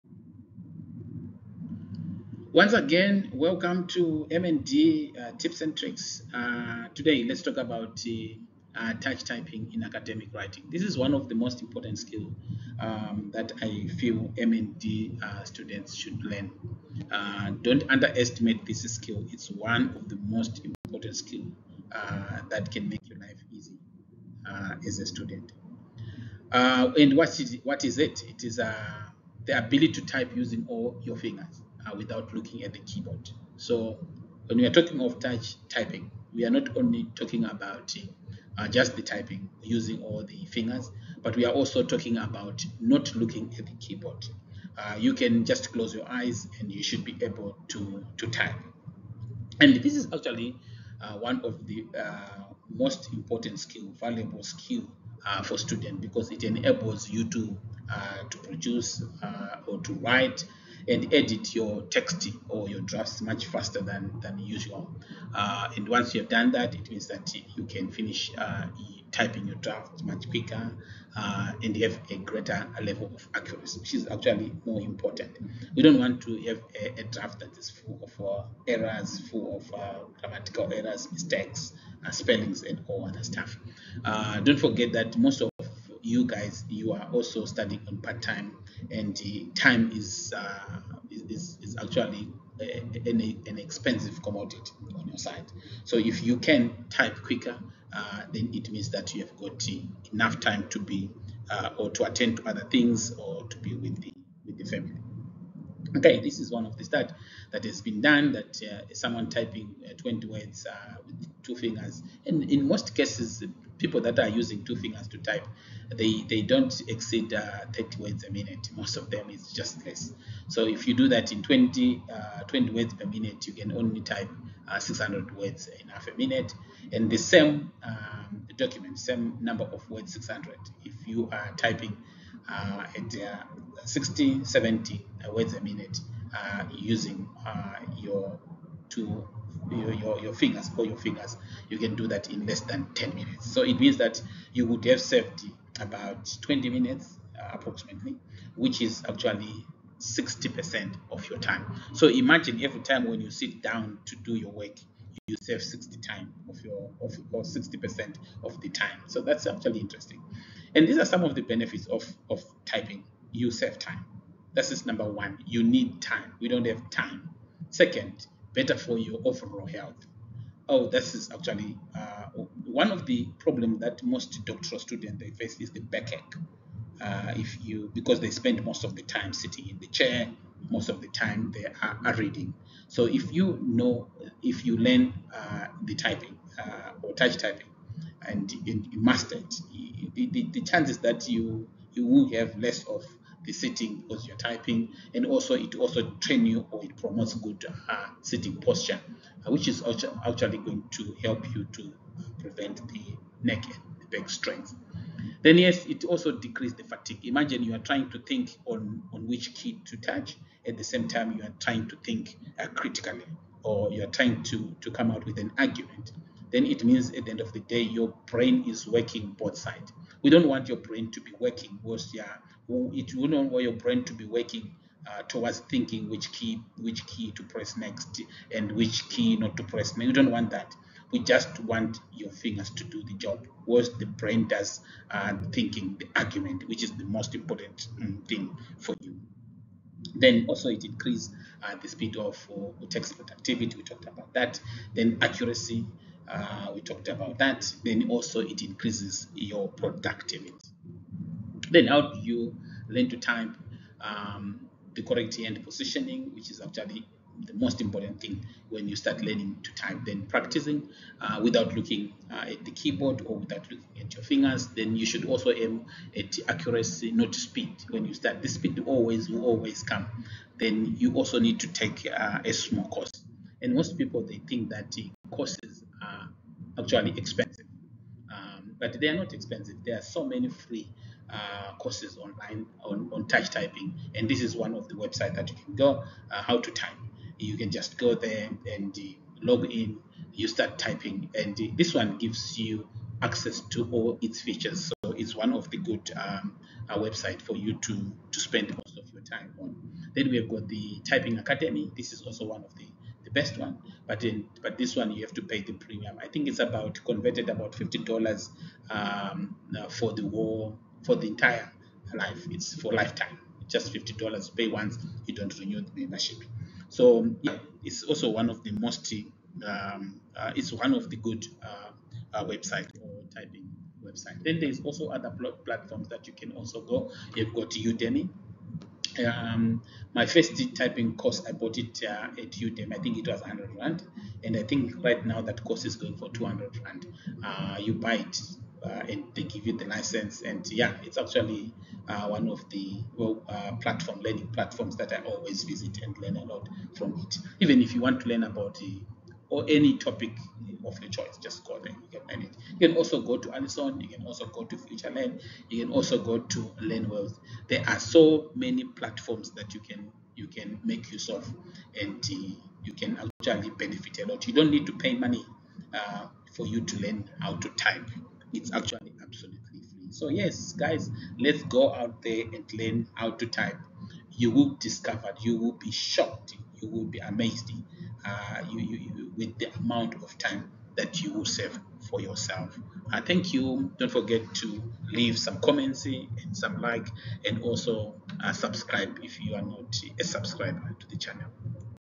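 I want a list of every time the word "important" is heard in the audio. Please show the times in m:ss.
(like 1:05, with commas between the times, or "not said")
0:11, 0:20, 0:53, 1:14, 3:57, 4:17.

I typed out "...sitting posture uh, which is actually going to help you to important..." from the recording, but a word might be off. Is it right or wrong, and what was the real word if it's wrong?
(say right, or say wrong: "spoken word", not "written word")
wrong: "prevent", not "important".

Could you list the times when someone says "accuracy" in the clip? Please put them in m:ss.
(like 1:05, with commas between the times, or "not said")
1:13, 4:05, 4:26.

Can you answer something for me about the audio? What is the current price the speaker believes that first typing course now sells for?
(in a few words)
200 Rand.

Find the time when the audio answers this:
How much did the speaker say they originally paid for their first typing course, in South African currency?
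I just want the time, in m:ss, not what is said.
5:33.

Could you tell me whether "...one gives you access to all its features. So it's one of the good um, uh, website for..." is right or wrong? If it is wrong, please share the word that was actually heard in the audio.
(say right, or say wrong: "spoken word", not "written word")
right.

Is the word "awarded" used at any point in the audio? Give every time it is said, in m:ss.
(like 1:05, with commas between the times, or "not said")
not said.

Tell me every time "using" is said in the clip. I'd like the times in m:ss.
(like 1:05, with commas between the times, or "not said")
0:30, 0:39, 1:54, 2:16.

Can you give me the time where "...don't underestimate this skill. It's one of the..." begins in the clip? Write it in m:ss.
0:17.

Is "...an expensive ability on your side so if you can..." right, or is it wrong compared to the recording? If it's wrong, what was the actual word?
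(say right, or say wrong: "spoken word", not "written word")
wrong: "commodity", not "ability".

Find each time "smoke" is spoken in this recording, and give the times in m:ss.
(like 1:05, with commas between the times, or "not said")
not said.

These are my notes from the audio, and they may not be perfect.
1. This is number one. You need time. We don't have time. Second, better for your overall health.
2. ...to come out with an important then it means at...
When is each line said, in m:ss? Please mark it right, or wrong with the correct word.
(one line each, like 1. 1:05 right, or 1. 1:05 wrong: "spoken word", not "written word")
1. 2:44 right
2. 3:34 wrong: "argument", not "important".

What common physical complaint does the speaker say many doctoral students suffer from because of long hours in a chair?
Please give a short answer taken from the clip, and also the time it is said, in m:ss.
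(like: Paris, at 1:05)
backache, at 2:55.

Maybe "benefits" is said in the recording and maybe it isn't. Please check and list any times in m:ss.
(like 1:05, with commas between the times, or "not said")
2:41, 6:03.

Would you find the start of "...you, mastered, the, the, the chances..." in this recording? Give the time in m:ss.
3:08.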